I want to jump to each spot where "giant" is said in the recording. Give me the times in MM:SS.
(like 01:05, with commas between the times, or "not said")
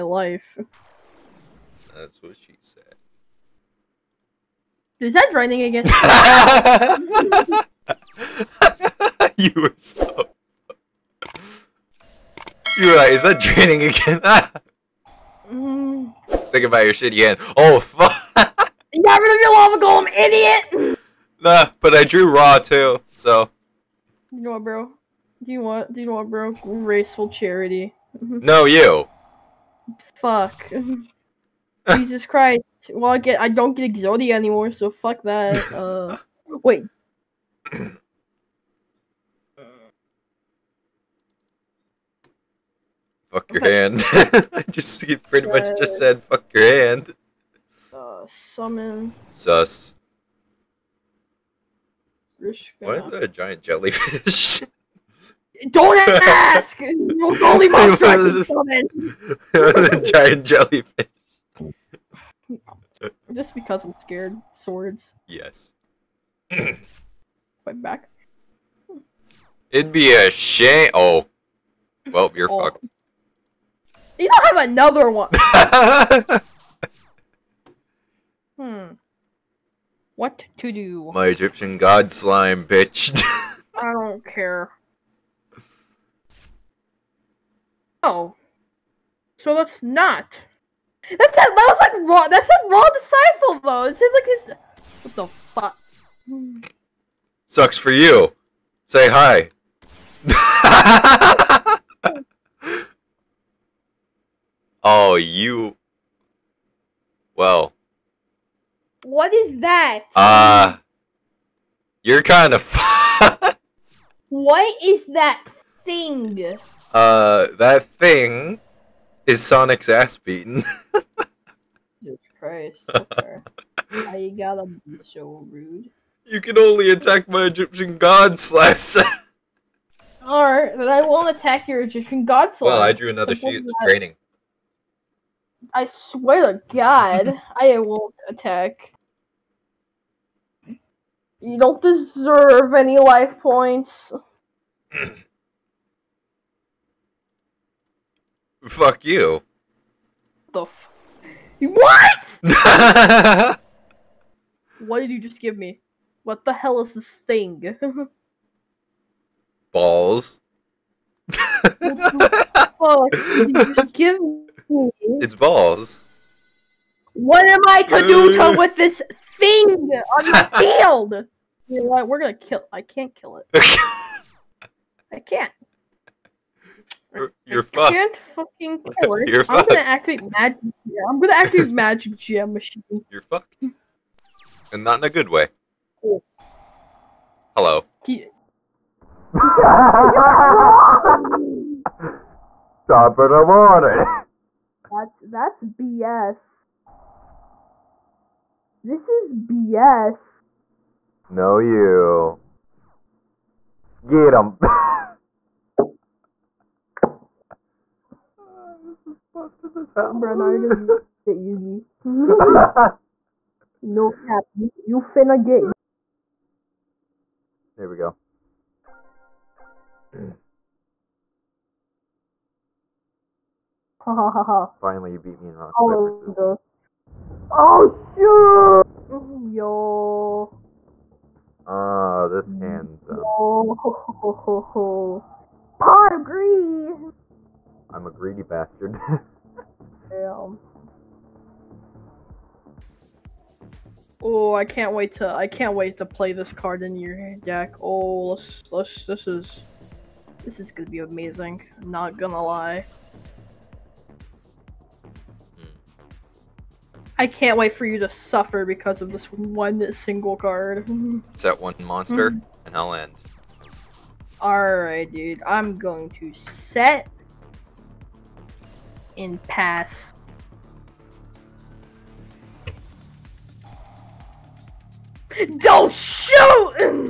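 00:53, 01:00.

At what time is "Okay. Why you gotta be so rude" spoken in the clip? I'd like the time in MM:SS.
02:02.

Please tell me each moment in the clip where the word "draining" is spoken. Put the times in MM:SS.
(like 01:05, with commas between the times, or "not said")
00:05, 00:13.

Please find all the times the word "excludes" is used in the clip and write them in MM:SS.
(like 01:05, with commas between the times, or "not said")
not said.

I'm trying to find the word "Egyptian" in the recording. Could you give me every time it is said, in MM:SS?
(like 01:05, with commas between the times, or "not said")
01:21, 02:07, 02:11.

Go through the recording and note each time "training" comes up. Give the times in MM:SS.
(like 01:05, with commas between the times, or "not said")
02:13.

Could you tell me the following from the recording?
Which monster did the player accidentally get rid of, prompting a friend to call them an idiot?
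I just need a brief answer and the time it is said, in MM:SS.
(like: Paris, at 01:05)
Lava Golem, at 00:19.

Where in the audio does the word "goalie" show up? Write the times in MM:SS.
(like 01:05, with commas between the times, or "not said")
00:57.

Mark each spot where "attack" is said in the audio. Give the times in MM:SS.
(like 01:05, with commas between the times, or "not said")
02:06, 02:11, 02:18.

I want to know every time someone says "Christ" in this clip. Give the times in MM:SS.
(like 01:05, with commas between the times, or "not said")
00:32, 02:02.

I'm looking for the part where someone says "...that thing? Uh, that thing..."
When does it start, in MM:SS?
01:55.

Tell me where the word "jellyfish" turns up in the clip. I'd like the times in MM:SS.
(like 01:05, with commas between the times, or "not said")
00:53, 01:00.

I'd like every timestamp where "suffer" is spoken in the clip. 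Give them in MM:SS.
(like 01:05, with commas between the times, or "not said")
04:18.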